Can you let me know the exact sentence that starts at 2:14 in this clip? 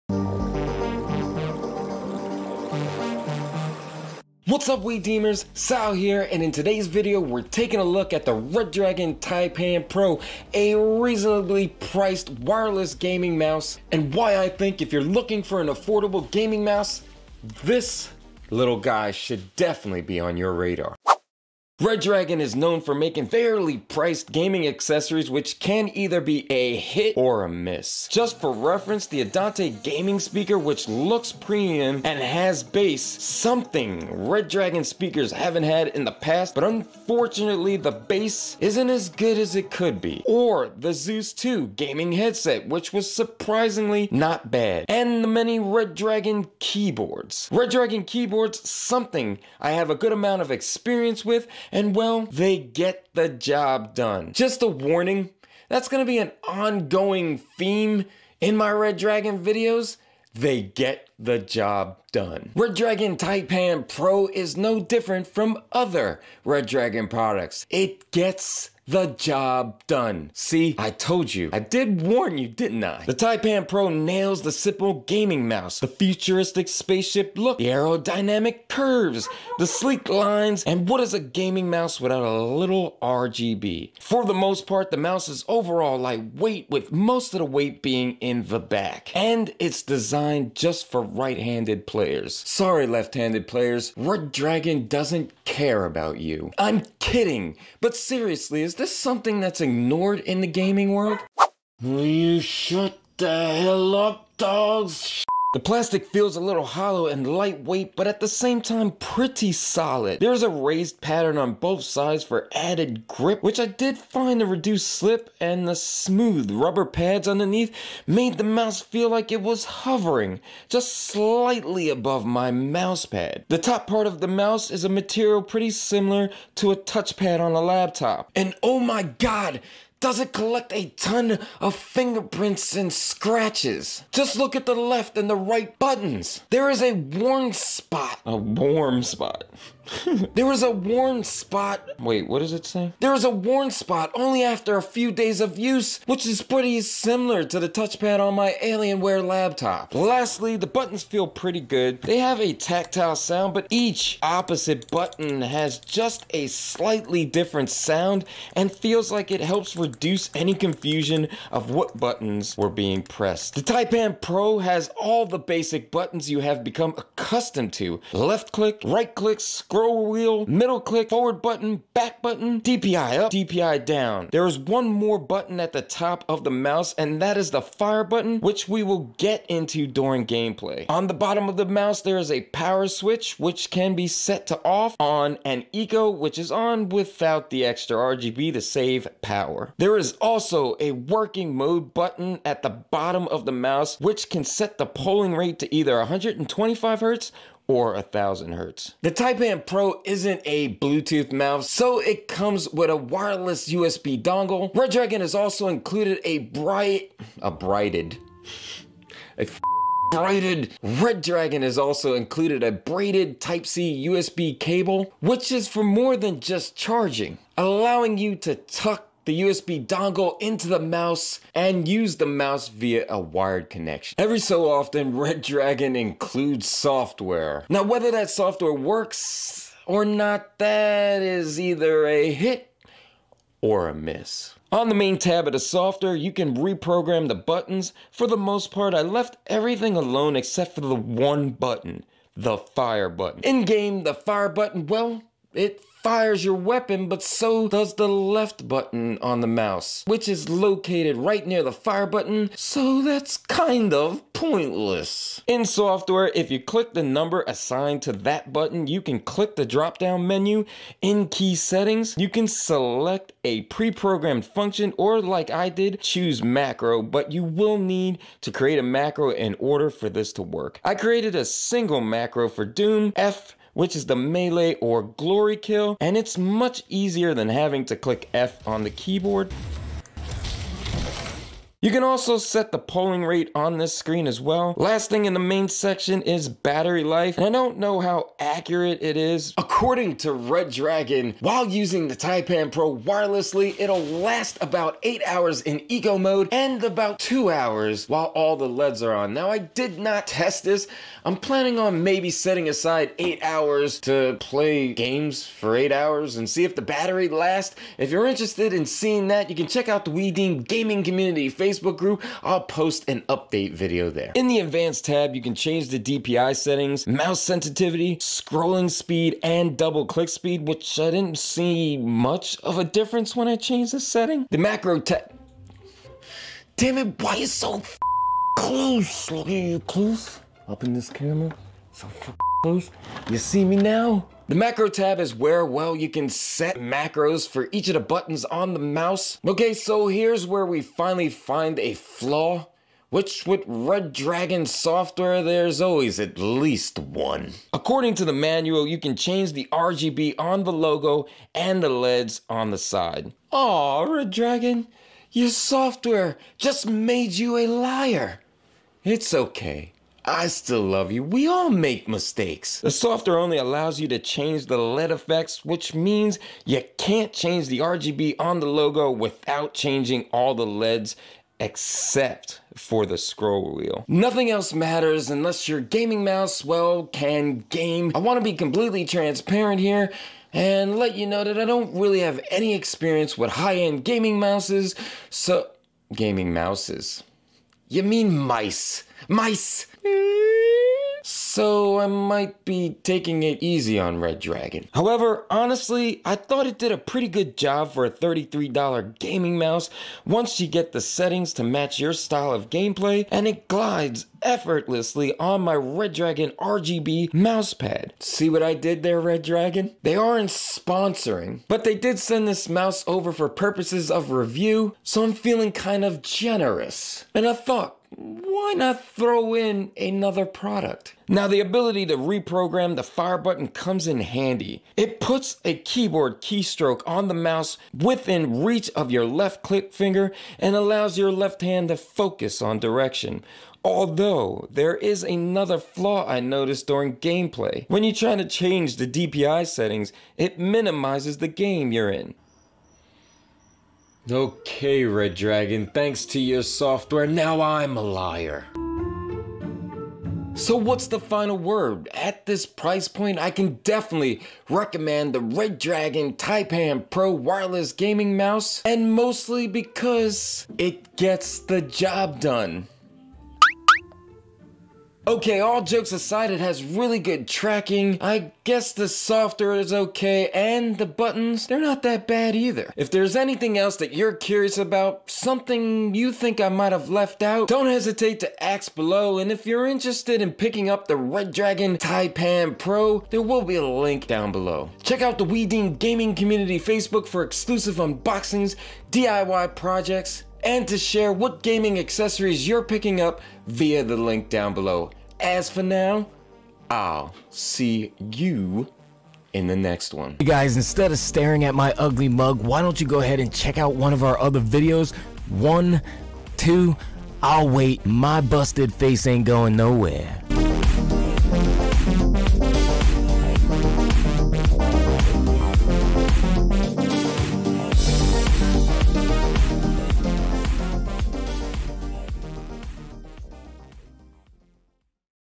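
Just look at the left and the right buttons.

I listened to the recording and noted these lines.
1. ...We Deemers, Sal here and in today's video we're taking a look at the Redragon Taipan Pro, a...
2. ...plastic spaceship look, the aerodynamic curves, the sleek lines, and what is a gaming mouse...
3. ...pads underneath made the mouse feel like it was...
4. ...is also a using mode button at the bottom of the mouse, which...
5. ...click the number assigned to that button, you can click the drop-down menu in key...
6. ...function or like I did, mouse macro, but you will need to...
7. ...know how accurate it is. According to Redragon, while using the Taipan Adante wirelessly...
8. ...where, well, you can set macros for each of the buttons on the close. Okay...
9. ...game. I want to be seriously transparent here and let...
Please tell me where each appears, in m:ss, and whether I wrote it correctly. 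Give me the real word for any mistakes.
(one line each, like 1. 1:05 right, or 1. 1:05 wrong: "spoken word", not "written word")
1. 0:04 right
2. 1:15 wrong: "futuristic", not "plastic"
3. 1:56 right
4. 3:09 wrong: "working", not "using"
5. 4:16 right
6. 4:24 wrong: "choose", not "mouse"
7. 4:47 wrong: "Pro", not "Adante"
8. 5:35 wrong: "mouse", not "close"
9. 6:17 wrong: "completely", not "seriously".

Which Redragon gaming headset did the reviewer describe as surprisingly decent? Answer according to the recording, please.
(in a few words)
Zeus 2.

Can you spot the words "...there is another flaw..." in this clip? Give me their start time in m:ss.
7:14.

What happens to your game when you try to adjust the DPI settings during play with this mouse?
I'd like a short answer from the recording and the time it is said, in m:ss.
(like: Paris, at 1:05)
It minimizes, at 7:20.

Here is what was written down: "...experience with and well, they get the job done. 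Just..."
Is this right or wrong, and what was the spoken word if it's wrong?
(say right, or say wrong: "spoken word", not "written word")
right.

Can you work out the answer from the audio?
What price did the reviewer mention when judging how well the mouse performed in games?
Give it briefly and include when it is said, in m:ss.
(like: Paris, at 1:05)
$33, at 6:38.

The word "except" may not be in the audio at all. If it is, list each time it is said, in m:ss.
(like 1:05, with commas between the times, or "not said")
4:00, 6:11.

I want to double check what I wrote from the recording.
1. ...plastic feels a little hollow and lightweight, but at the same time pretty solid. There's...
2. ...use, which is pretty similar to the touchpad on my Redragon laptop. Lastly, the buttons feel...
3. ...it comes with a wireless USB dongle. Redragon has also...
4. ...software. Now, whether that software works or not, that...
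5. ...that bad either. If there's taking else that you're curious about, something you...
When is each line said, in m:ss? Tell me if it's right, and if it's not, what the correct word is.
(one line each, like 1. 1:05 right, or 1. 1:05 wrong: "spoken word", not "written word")
1. 1:45 right
2. 2:25 wrong: "Alienware", not "Redragon"
3. 3:21 right
4. 3:46 right
5. 7:52 wrong: "anything", not "taking".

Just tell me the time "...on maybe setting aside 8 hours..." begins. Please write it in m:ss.
5:01.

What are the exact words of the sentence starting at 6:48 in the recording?
See what I did there, Redragon?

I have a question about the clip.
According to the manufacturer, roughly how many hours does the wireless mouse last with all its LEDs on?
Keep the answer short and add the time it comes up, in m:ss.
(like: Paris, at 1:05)
2 hours, at 4:57.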